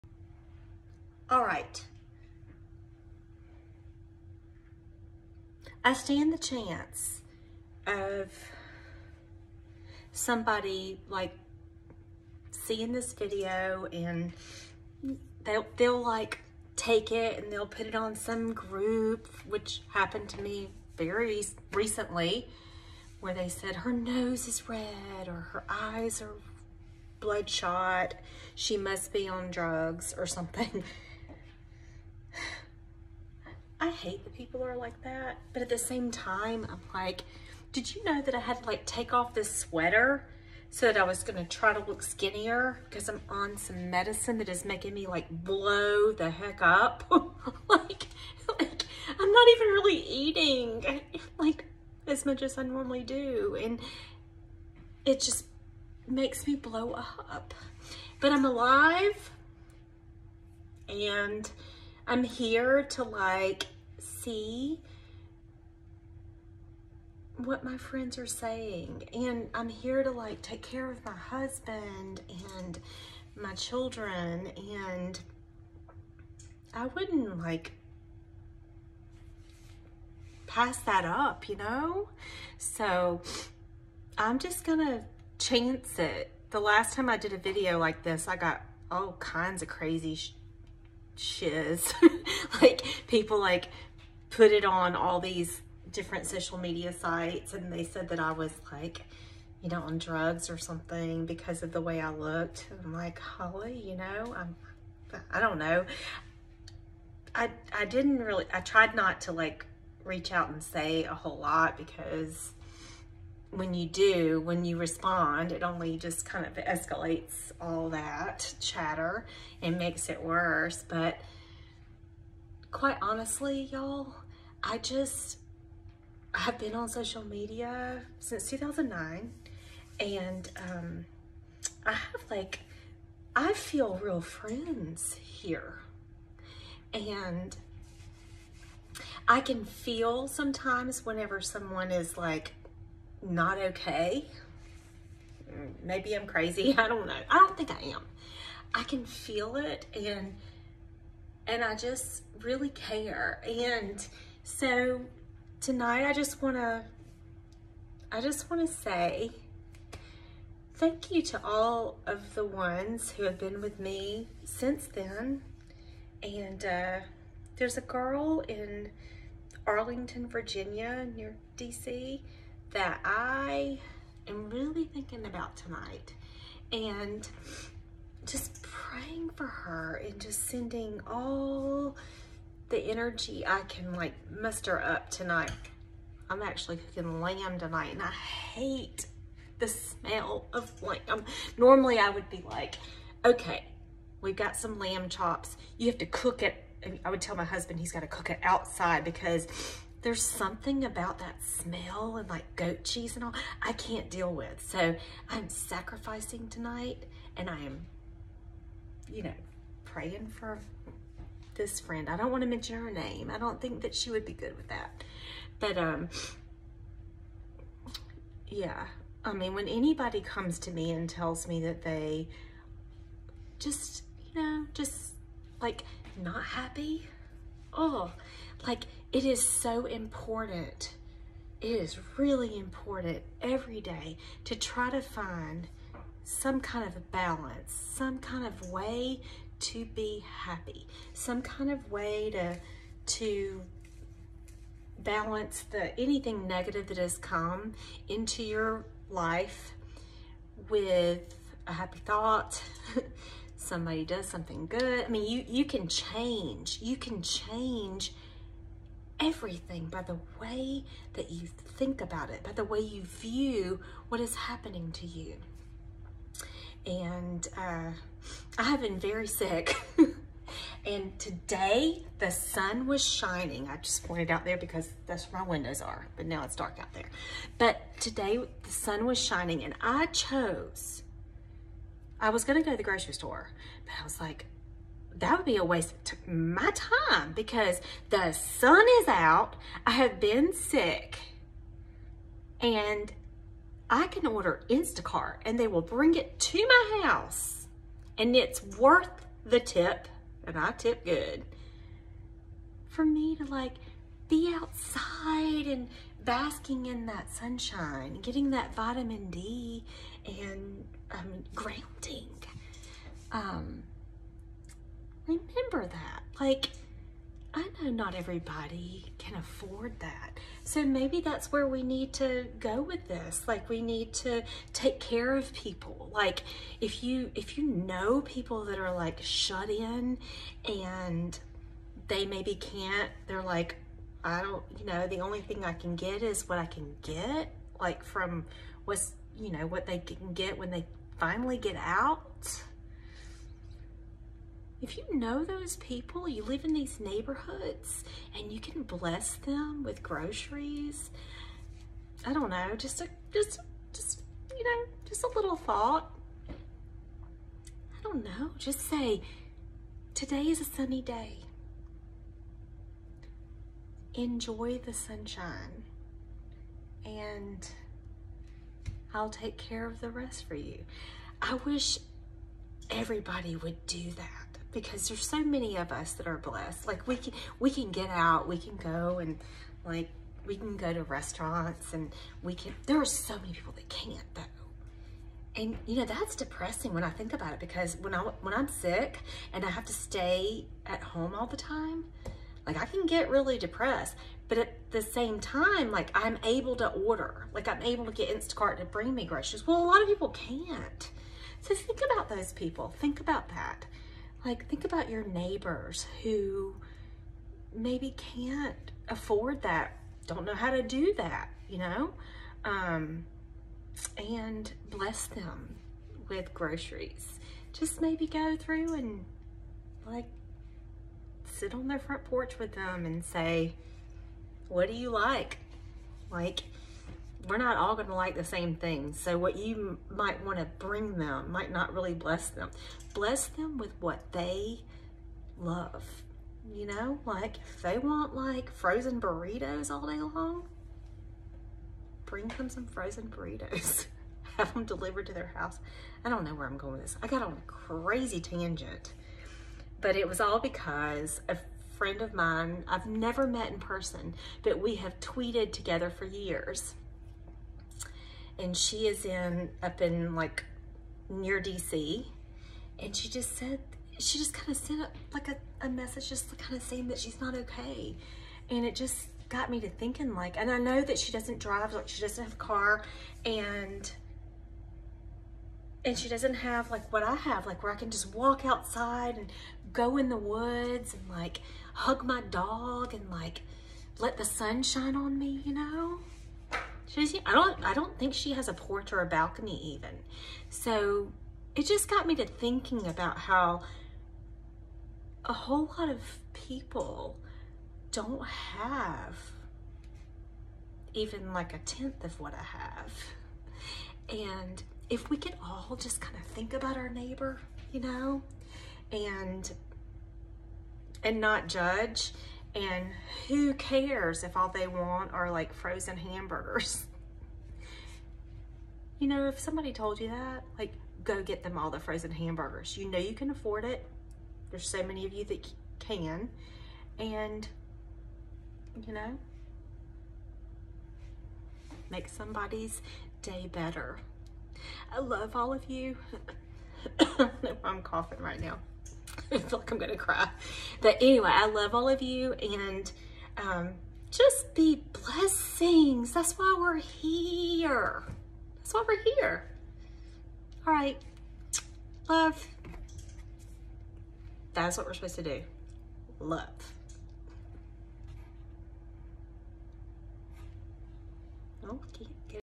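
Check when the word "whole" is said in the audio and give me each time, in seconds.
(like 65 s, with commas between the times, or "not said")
111 s, 495 s.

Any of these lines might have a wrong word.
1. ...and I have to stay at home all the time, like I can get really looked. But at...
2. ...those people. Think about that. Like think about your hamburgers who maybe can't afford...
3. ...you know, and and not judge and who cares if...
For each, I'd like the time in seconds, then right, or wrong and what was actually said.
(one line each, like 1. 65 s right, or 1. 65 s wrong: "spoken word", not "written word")
1. 389 s wrong: "depressed", not "looked"
2. 402 s wrong: "neighbors", not "hamburgers"
3. 507 s right.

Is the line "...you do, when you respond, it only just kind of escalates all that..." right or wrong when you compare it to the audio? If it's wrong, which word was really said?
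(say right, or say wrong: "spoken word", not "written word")
right.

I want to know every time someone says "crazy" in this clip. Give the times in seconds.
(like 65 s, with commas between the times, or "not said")
89 s, 146 s, 447 s.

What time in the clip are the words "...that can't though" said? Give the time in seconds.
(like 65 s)
383 s.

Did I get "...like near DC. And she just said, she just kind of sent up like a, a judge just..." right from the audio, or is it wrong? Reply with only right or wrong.
wrong.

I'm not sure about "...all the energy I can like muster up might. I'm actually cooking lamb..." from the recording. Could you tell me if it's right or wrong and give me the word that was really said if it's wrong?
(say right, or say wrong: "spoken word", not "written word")
wrong: "tonight", not "might".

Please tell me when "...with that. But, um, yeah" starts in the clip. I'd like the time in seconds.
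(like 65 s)
214 s.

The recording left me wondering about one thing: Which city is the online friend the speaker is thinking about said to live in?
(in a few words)
Arlington, Virginia.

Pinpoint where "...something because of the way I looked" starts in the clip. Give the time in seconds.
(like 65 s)
100 s.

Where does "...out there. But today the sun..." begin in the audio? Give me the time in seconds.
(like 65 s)
276 s.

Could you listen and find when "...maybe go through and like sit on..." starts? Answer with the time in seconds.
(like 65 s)
418 s.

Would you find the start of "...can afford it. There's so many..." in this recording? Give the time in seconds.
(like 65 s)
523 s.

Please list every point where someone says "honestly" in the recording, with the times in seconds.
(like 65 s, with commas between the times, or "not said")
123 s.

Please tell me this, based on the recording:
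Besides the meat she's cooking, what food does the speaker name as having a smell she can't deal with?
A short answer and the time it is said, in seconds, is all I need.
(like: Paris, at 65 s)
Goat cheese, at 202 s.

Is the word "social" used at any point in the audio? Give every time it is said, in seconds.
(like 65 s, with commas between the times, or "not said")
96 s, 126 s.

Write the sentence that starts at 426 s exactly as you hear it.
Like, we're not all going to like the same thing.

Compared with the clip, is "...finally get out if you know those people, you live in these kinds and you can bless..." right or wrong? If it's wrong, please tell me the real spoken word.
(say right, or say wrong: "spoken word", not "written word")
wrong: "neighborhoods", not "kinds".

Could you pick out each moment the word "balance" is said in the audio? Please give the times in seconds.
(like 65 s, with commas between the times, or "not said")
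237 s, 244 s.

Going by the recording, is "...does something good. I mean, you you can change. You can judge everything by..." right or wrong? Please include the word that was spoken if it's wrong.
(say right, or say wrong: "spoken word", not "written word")
wrong: "change", not "judge".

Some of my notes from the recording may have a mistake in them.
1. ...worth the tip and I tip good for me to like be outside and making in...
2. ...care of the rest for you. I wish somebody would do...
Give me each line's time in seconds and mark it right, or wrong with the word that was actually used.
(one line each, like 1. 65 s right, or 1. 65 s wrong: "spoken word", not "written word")
1. 298 s wrong: "basking", not "making"
2. 369 s wrong: "everybody", not "somebody".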